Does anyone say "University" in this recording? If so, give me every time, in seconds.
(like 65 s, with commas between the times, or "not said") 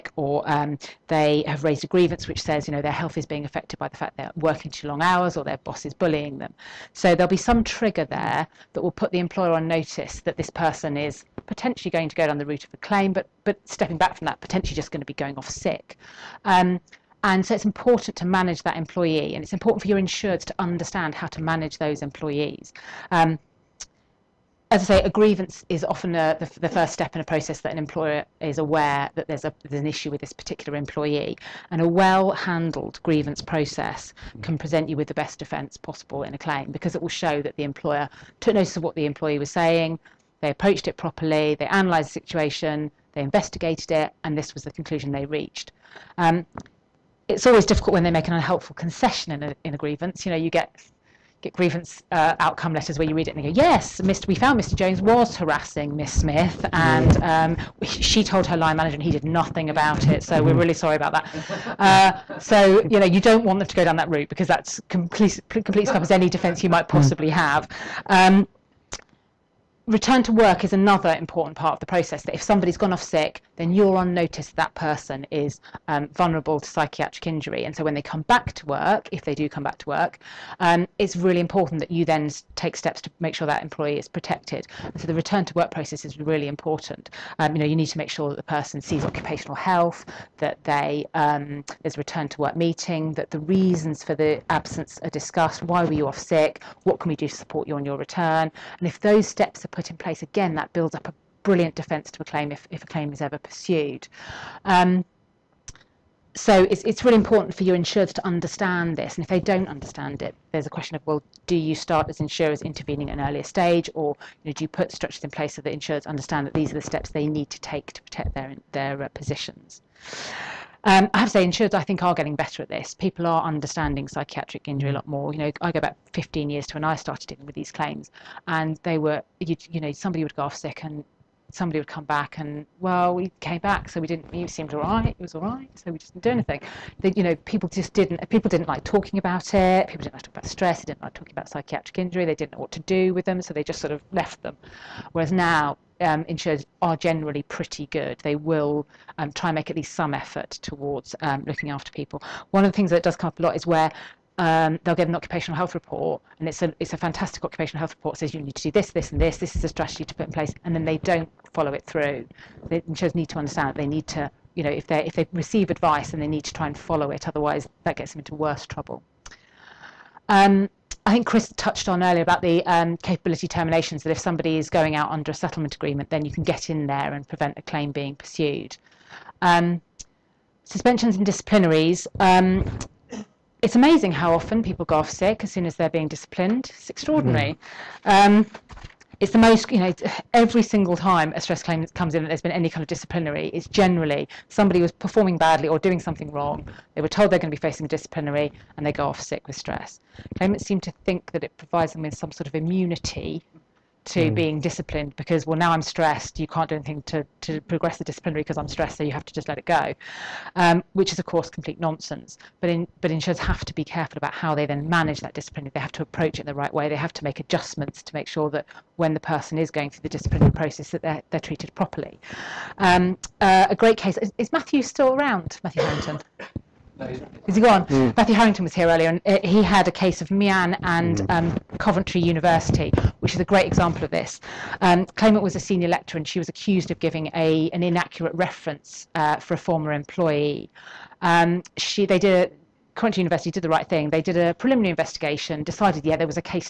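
232 s, 243 s.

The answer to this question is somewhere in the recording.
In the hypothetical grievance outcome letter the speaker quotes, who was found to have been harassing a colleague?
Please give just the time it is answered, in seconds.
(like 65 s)
54 s.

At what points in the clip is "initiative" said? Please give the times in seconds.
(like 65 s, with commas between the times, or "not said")
not said.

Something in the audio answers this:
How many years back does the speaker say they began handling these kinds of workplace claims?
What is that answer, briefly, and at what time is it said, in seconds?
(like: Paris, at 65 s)
15, at 126 s.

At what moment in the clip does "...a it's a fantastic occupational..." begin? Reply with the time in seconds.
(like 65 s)
156 s.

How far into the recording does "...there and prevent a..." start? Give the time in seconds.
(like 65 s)
176 s.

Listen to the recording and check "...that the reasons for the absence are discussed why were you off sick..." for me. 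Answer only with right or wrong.
right.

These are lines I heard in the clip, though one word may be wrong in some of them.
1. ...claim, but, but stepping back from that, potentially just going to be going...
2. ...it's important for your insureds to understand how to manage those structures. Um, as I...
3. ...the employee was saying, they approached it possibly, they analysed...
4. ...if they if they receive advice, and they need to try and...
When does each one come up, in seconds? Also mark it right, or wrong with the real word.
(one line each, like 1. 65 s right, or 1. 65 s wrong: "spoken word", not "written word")
1. 12 s right
2. 19 s wrong: "employees", not "structures"
3. 38 s wrong: "properly", not "possibly"
4. 164 s right.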